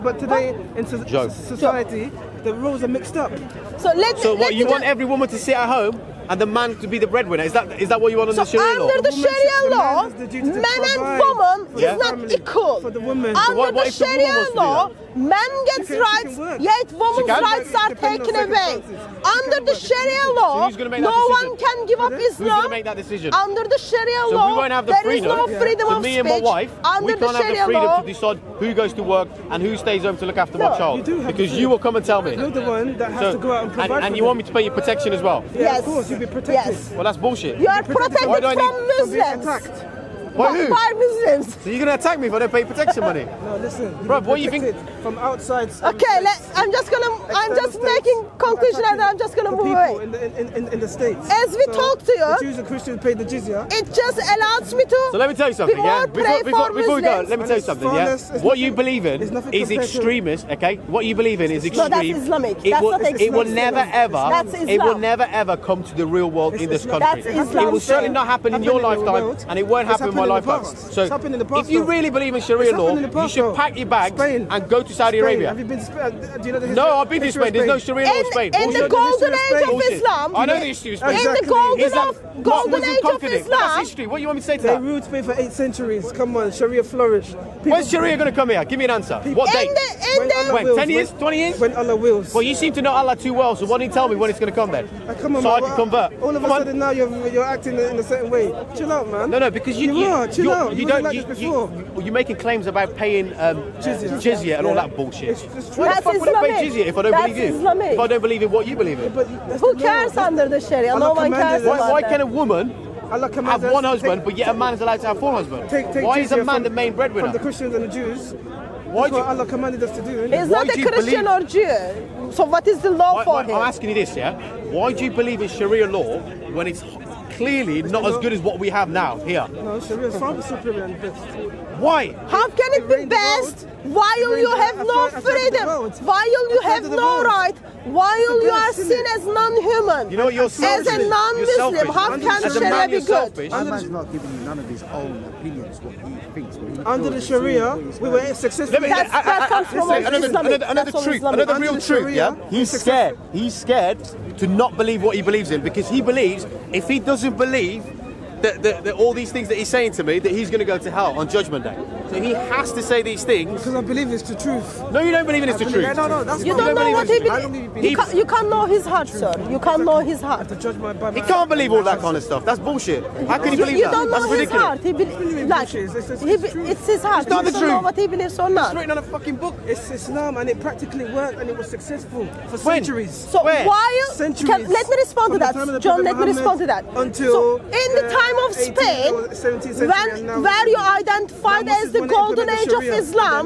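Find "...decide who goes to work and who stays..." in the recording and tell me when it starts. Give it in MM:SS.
00:28.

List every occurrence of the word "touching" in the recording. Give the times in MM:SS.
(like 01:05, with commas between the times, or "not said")
not said.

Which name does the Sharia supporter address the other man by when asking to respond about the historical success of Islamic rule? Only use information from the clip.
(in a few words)
John.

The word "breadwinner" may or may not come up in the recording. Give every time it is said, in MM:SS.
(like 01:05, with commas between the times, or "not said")
00:07, 01:56.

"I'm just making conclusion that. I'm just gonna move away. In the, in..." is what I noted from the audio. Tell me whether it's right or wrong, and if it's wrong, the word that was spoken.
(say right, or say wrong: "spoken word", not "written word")
right.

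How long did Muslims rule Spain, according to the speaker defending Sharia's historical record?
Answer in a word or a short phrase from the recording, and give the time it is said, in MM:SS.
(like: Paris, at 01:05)
8 centuries, at 01:25.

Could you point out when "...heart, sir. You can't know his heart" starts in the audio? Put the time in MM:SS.
02:48.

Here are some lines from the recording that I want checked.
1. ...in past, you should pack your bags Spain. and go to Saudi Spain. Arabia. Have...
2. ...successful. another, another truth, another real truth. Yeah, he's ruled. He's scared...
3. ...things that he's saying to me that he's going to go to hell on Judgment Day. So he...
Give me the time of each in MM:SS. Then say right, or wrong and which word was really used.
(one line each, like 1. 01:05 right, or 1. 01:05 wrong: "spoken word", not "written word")
1. 01:12 right
2. 02:28 wrong: "scared", not "ruled"
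3. 02:39 right.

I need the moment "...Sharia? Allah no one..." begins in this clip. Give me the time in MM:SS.
01:50.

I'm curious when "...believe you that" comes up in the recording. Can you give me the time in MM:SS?
02:53.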